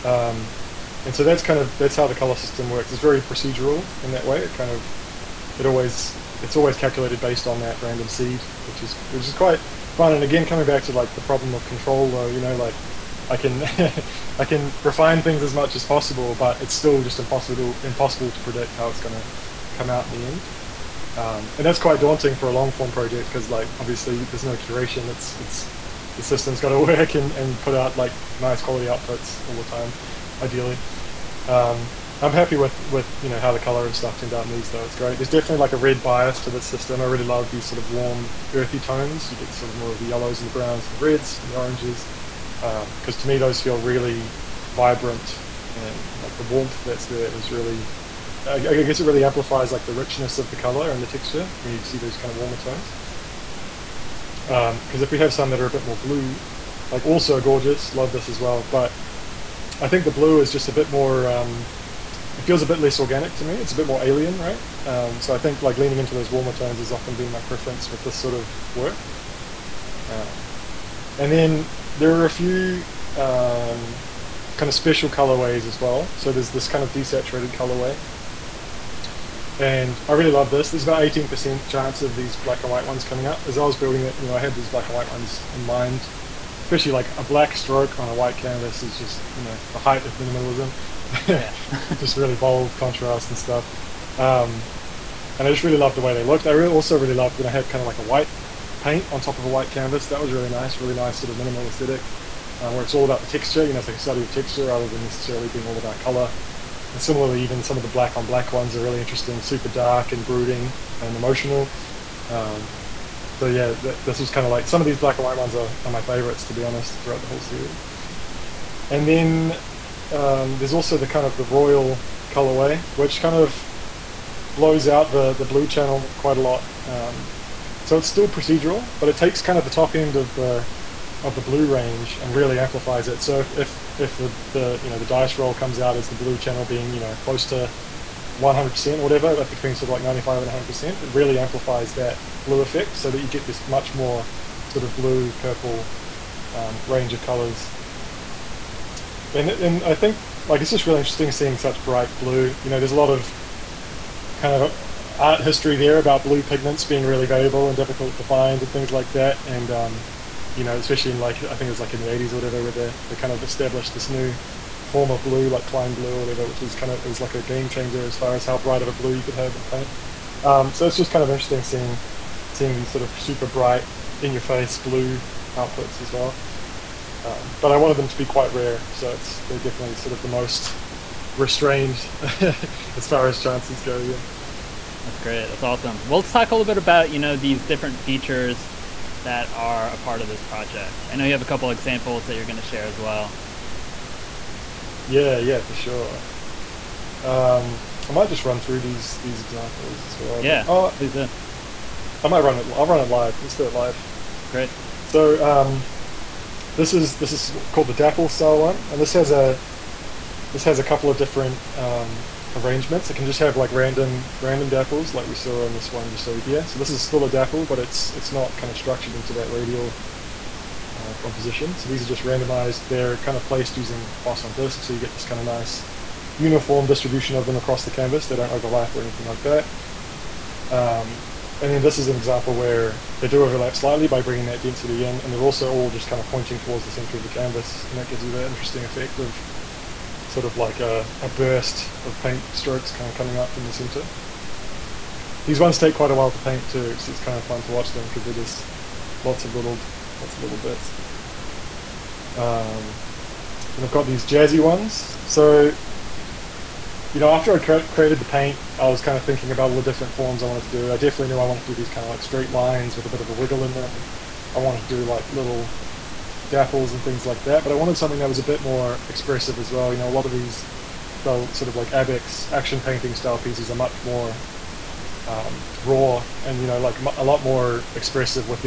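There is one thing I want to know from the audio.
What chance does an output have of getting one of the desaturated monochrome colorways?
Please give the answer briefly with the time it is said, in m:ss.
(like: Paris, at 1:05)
18%, at 1:21.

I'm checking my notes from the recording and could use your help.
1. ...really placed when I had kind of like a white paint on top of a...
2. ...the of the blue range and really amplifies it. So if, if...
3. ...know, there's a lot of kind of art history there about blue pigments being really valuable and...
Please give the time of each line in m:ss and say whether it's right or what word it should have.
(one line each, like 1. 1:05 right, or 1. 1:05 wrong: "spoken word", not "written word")
1. 1:36 wrong: "loved", not "placed"
2. 2:10 right
3. 2:32 right.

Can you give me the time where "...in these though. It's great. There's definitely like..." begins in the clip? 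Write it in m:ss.
0:34.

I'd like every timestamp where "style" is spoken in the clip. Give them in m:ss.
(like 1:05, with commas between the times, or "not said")
3:28, 4:33.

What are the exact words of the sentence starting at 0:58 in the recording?
But I think the blue is just a bit more.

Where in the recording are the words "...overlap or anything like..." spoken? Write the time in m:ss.
3:48.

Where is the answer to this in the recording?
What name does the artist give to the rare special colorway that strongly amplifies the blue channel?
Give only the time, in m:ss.
2:01.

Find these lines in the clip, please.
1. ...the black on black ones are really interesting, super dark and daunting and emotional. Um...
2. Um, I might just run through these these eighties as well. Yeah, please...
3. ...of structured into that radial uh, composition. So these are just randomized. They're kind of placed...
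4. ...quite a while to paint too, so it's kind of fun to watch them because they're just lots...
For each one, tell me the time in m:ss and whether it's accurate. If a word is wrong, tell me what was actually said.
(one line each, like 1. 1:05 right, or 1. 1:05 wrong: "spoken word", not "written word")
1. 1:47 wrong: "brooding", not "daunting"
2. 3:17 wrong: "examples", not "eighties"
3. 3:38 right
4. 4:05 right.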